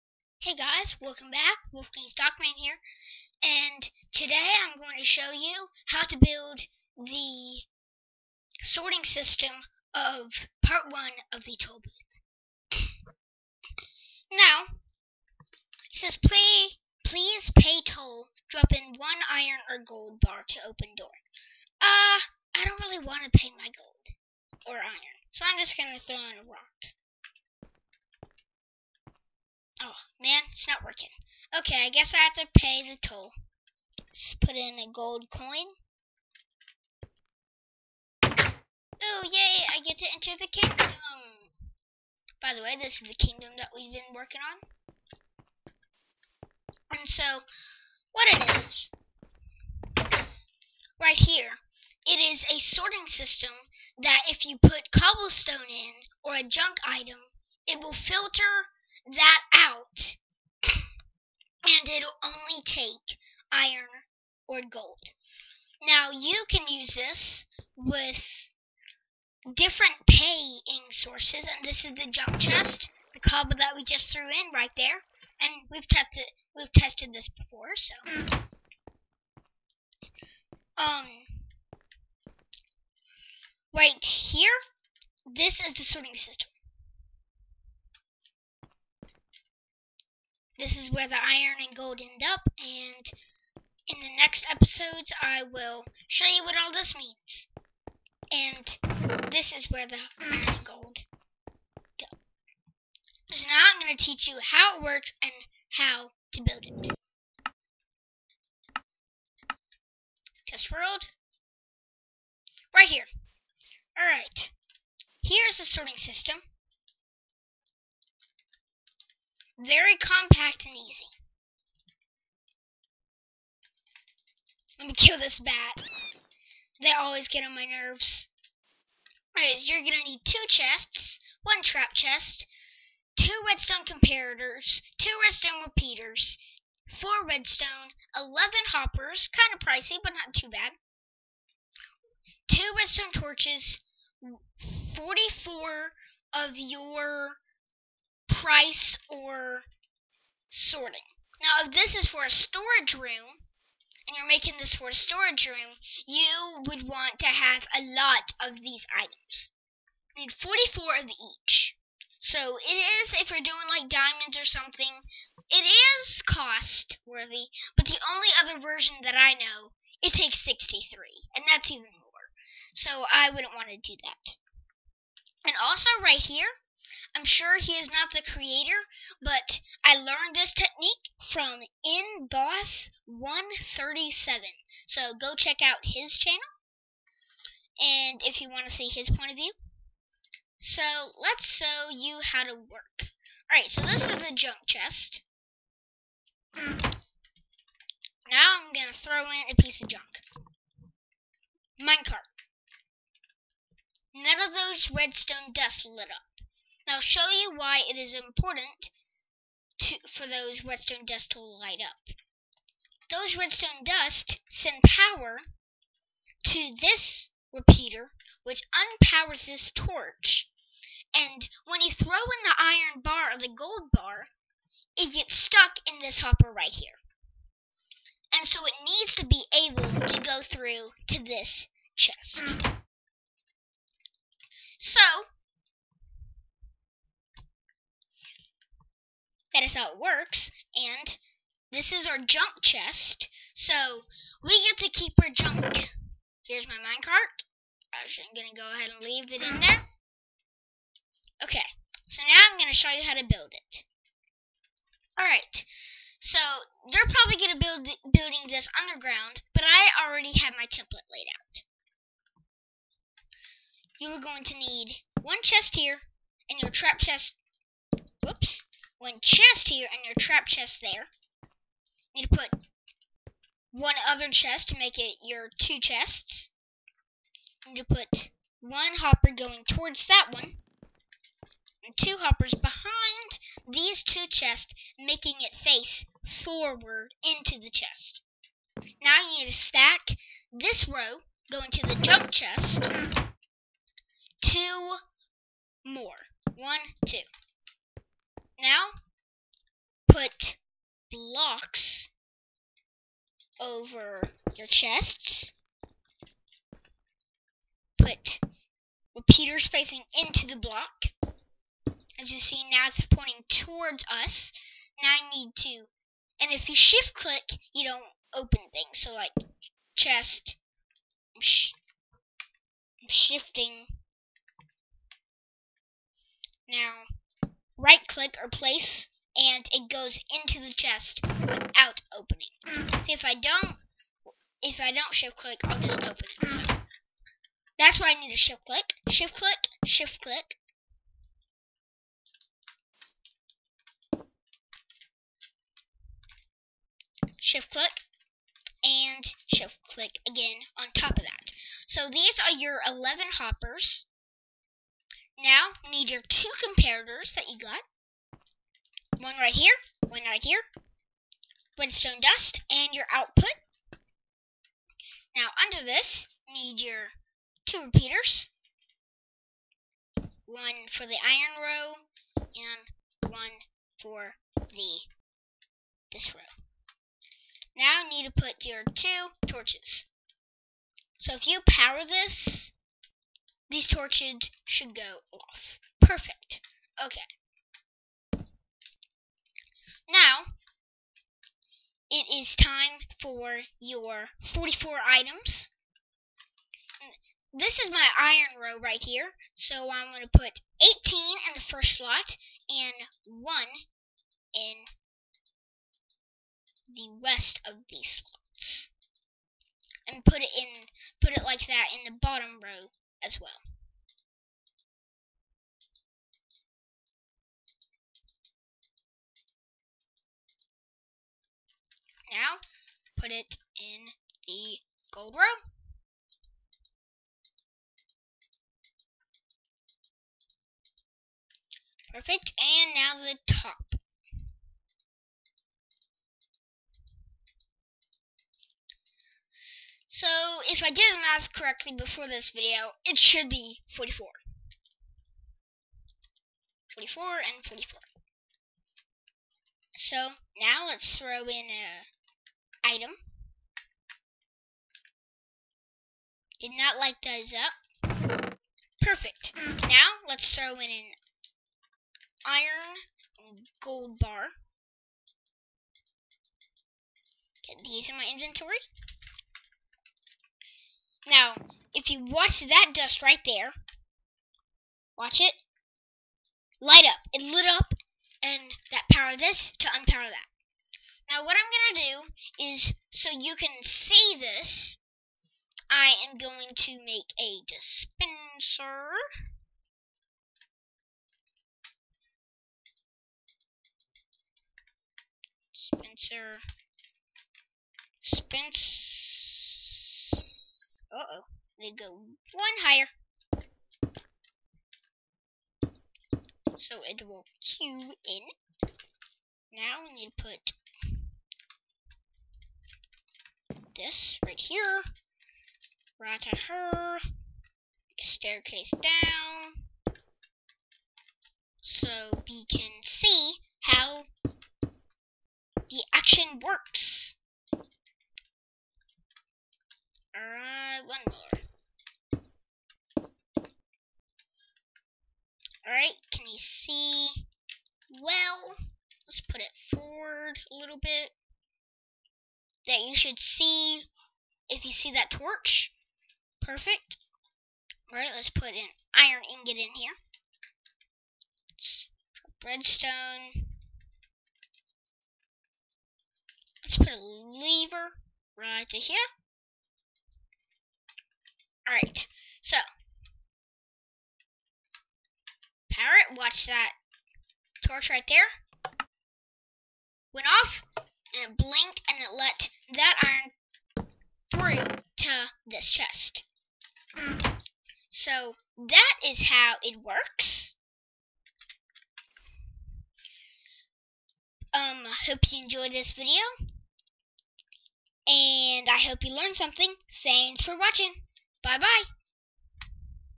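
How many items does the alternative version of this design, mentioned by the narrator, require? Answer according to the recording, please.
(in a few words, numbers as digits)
63.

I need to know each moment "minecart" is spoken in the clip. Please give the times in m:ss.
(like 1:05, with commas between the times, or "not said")
3:21, 4:06.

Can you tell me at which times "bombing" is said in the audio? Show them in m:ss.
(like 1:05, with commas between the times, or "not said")
not said.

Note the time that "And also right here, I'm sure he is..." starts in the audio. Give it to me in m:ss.
2:55.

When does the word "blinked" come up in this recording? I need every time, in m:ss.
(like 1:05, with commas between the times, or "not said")
9:31.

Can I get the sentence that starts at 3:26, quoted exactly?
Now show you why it is important to, for those redstone dust to light up.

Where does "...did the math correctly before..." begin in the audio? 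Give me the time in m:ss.
7:20.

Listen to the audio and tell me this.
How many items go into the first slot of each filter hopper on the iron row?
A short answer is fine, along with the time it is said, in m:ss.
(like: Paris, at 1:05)
18, at 6:41.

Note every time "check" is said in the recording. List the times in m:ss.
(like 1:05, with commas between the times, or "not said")
3:05.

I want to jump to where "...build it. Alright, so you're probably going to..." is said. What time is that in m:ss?
4:13.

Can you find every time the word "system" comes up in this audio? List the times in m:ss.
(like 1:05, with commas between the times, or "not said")
0:09, 0:53, 1:26, 1:55.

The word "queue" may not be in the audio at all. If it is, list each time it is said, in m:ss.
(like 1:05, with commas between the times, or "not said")
8:27.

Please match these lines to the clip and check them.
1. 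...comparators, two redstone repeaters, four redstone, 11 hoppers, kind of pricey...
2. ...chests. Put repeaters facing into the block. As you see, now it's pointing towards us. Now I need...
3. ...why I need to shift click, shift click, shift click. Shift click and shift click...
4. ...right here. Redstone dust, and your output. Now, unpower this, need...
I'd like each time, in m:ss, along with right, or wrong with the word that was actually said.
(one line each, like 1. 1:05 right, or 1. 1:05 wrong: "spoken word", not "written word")
1. 2:13 right
2. 5:04 right
3. 5:37 right
4. 6:00 wrong: "under", not "unpower".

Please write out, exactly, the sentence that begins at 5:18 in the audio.
So like chest, I'm, sh I'm shifting.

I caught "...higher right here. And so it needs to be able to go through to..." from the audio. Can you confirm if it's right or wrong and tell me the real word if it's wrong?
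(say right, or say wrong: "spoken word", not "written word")
wrong: "hopper", not "higher".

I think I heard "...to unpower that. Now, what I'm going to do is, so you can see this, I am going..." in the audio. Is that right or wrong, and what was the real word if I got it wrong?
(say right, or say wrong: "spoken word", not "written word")
right.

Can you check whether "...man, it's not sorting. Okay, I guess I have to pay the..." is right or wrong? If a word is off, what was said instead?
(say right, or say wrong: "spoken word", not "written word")
wrong: "working", not "sorting".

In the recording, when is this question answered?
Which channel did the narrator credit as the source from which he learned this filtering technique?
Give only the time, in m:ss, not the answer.
3:01.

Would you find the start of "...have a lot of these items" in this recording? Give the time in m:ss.
2:37.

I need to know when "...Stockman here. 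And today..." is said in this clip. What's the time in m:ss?
0:02.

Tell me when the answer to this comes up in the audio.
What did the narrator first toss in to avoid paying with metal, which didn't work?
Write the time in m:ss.
0:26.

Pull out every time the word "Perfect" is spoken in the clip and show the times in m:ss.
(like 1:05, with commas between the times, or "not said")
6:26, 7:12, 7:39, 9:06.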